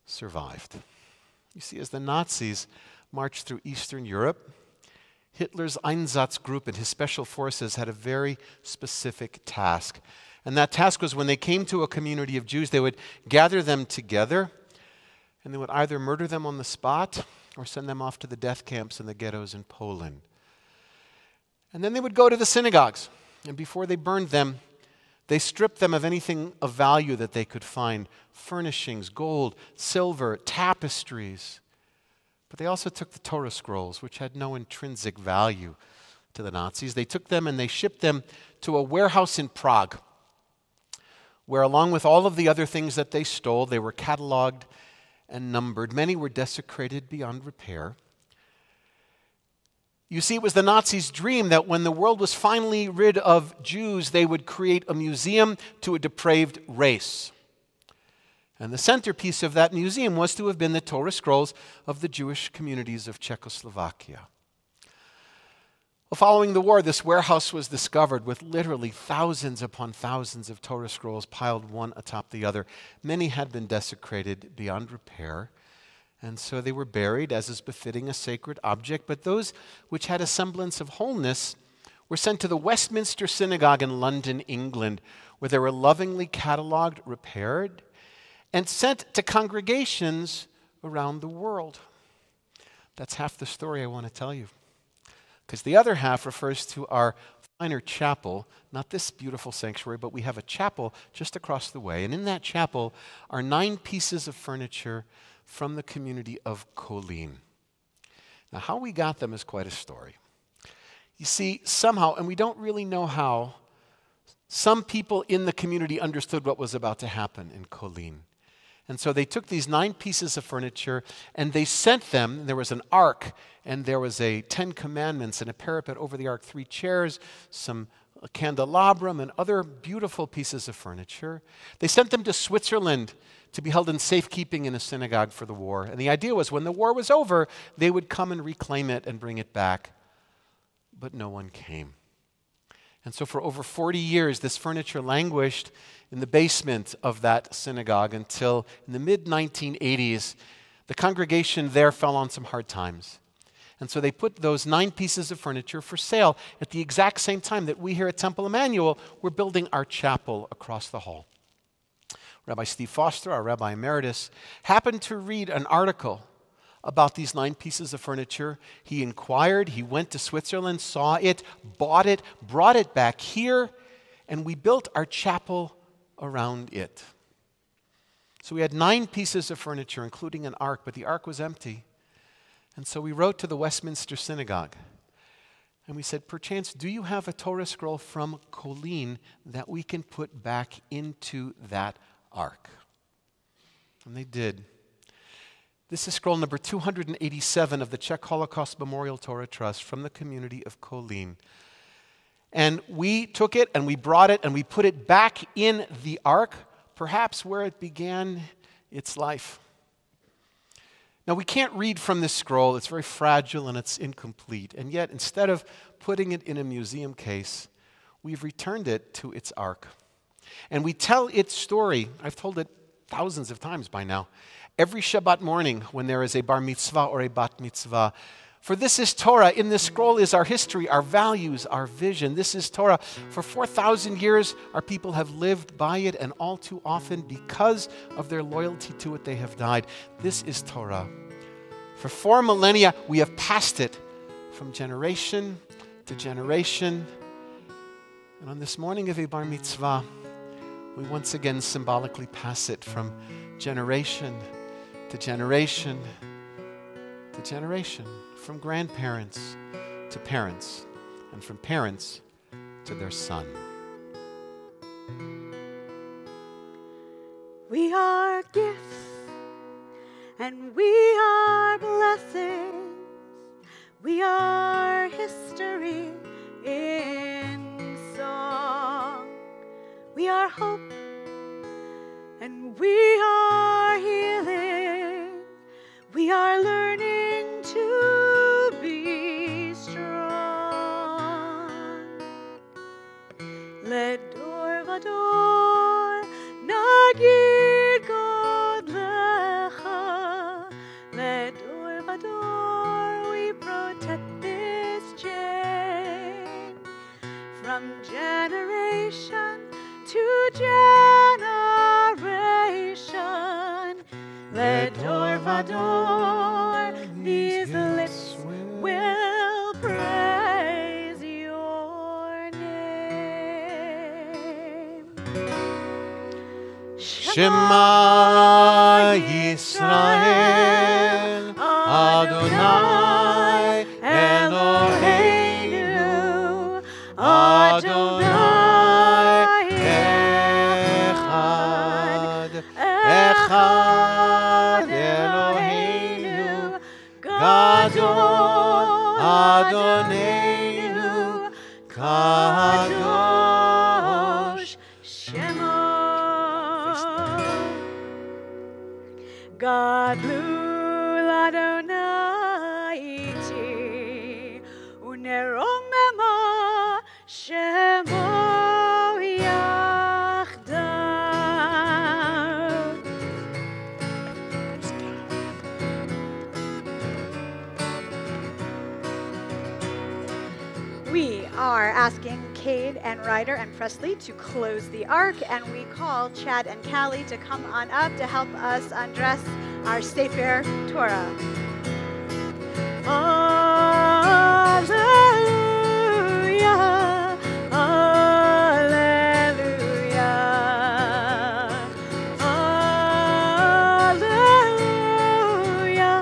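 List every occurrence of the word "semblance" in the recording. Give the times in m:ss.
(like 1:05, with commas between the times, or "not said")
1:20.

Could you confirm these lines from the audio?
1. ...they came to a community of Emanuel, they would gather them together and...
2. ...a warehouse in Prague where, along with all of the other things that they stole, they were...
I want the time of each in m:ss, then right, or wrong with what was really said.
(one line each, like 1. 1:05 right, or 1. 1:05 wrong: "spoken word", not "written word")
1. 0:11 wrong: "Jews", not "Emanuel"
2. 0:38 right.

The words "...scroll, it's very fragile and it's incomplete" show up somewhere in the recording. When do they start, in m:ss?
3:32.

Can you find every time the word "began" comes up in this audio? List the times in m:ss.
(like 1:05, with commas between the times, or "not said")
3:27.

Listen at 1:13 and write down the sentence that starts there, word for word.
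Many had been desecrated beyond repair, and so they were buried as is befitting a sacred object.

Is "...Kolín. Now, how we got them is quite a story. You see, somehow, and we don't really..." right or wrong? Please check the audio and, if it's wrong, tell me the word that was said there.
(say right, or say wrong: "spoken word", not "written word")
right.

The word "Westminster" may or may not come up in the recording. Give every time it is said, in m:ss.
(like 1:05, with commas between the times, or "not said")
1:22, 3:03.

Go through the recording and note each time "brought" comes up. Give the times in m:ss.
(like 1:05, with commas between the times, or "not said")
2:52, 3:23.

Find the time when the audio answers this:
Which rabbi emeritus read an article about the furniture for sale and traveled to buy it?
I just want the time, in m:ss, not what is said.
2:42.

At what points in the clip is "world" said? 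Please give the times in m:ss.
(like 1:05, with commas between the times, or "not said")
0:51, 1:31.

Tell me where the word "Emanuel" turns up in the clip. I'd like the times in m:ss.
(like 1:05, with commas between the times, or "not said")
2:38.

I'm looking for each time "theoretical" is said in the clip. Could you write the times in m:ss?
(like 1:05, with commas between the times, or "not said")
not said.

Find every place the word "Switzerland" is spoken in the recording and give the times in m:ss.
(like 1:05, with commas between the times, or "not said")
2:12, 2:50.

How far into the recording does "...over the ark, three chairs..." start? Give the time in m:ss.
2:05.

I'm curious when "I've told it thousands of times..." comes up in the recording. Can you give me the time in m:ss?
3:42.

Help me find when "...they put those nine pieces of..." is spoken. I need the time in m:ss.
2:33.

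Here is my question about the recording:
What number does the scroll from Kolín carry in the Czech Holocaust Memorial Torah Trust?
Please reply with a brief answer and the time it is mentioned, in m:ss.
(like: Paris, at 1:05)
287, at 3:16.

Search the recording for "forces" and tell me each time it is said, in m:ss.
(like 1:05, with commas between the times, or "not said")
0:07.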